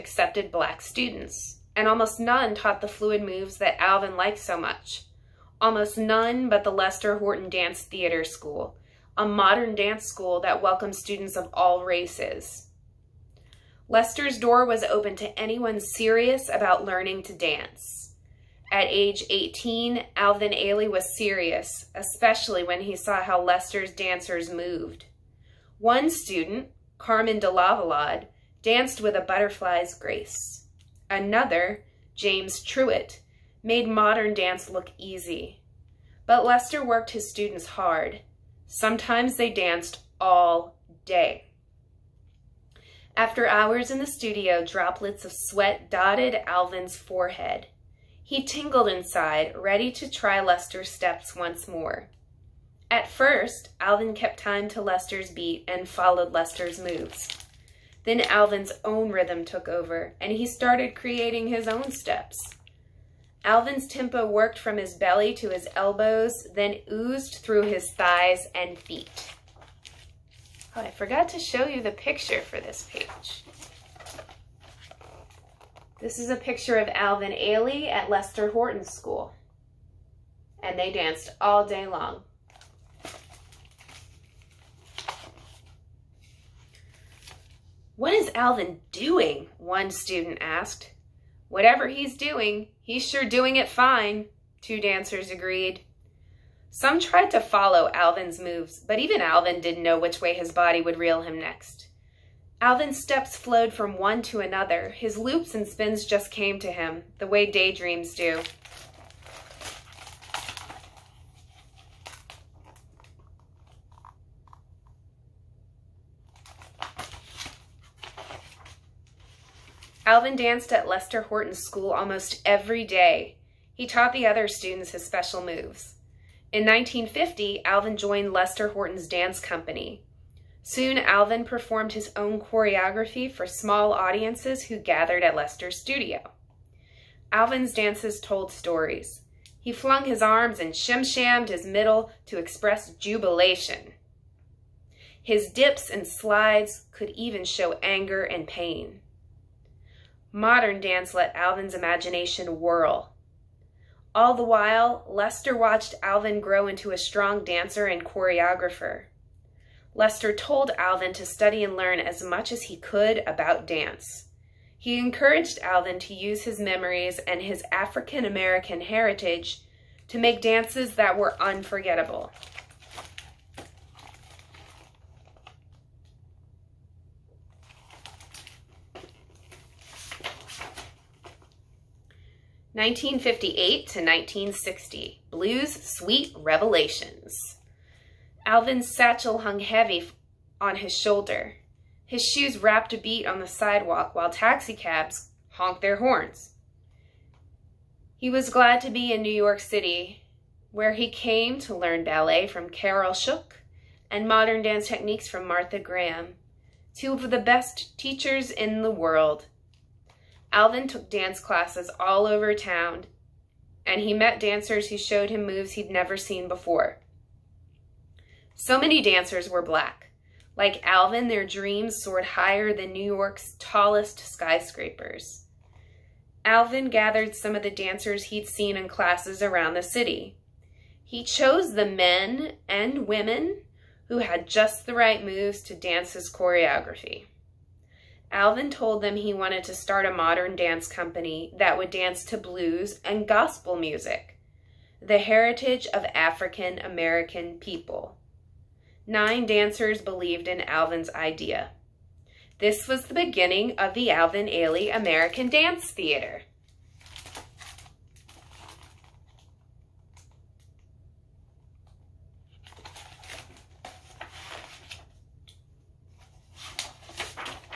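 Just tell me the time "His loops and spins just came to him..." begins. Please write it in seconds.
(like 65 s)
104 s.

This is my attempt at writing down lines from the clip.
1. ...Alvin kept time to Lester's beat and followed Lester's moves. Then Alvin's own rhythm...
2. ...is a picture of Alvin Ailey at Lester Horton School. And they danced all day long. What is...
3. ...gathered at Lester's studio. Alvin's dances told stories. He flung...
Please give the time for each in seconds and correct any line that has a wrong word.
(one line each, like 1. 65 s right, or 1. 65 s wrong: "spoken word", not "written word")
1. 53 s right
2. 76 s right
3. 134 s right.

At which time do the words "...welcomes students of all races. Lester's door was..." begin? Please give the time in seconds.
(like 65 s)
10 s.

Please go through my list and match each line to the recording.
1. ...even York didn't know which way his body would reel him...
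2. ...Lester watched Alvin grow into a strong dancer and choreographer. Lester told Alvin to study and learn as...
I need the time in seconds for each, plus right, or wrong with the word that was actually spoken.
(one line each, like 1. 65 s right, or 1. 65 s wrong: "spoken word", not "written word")
1. 98 s wrong: "Alvin", not "York"
2. 155 s right.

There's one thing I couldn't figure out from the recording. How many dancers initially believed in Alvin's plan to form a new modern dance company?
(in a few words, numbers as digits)
9.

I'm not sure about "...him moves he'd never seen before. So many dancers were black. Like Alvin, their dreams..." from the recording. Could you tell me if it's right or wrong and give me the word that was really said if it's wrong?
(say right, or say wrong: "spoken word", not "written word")
right.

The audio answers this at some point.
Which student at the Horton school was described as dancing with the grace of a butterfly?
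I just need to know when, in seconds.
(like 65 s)
26 s.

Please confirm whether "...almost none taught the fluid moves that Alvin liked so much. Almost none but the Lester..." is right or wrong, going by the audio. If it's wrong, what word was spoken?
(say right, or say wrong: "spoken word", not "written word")
right.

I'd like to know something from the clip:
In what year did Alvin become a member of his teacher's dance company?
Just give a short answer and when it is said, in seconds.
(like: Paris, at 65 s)
1950, at 126 s.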